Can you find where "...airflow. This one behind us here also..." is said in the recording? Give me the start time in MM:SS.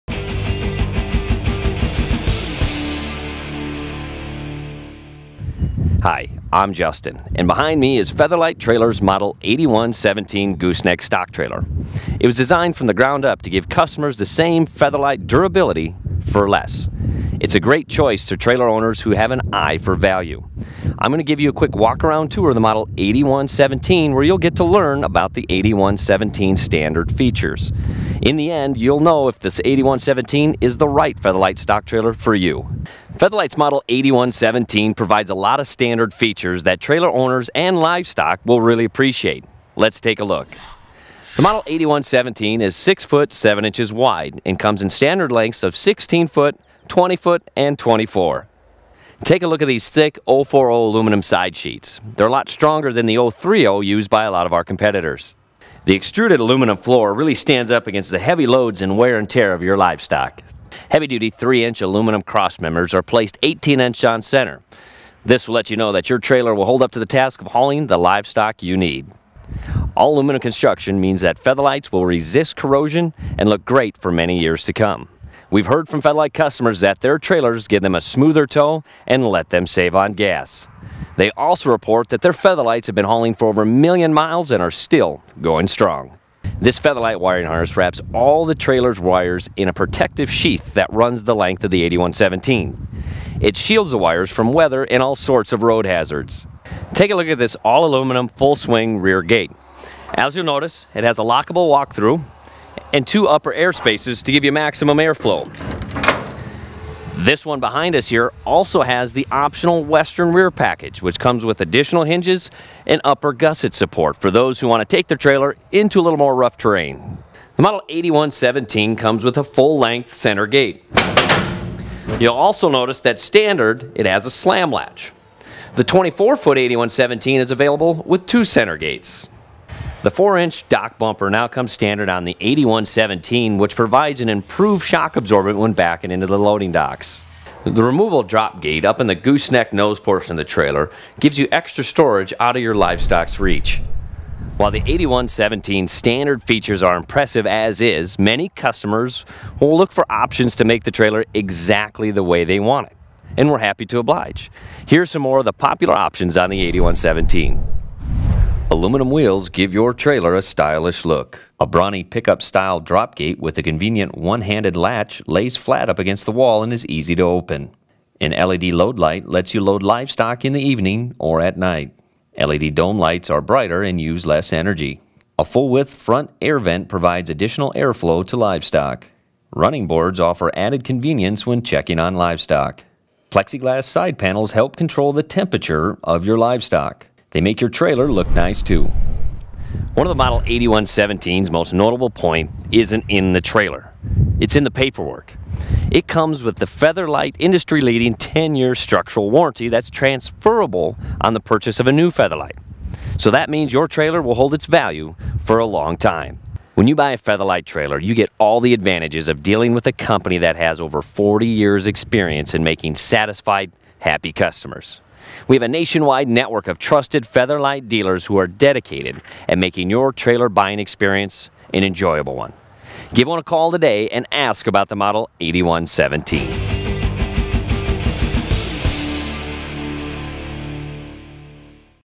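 01:44.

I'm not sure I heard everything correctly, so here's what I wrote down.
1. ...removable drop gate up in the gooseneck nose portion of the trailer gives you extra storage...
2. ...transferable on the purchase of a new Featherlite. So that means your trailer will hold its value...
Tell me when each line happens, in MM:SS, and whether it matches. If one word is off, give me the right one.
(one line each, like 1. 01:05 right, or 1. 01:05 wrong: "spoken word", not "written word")
1. 02:17 right
2. 03:19 right.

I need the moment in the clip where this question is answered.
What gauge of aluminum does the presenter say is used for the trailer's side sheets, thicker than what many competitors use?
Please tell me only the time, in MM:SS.
00:50.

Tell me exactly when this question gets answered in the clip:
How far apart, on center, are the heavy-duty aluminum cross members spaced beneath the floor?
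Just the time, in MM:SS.
01:03.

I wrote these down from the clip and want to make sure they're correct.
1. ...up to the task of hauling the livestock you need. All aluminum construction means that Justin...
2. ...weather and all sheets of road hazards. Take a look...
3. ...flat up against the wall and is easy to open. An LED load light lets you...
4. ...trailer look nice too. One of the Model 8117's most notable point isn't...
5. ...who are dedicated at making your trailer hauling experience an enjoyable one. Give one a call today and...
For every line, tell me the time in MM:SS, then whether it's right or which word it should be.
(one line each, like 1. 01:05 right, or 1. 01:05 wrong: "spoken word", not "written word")
1. 01:06 wrong: "Featherlites", not "Justin"
2. 01:34 wrong: "sorts", not "sheets"
3. 02:45 right
4. 03:07 right
5. 03:38 wrong: "buying", not "hauling".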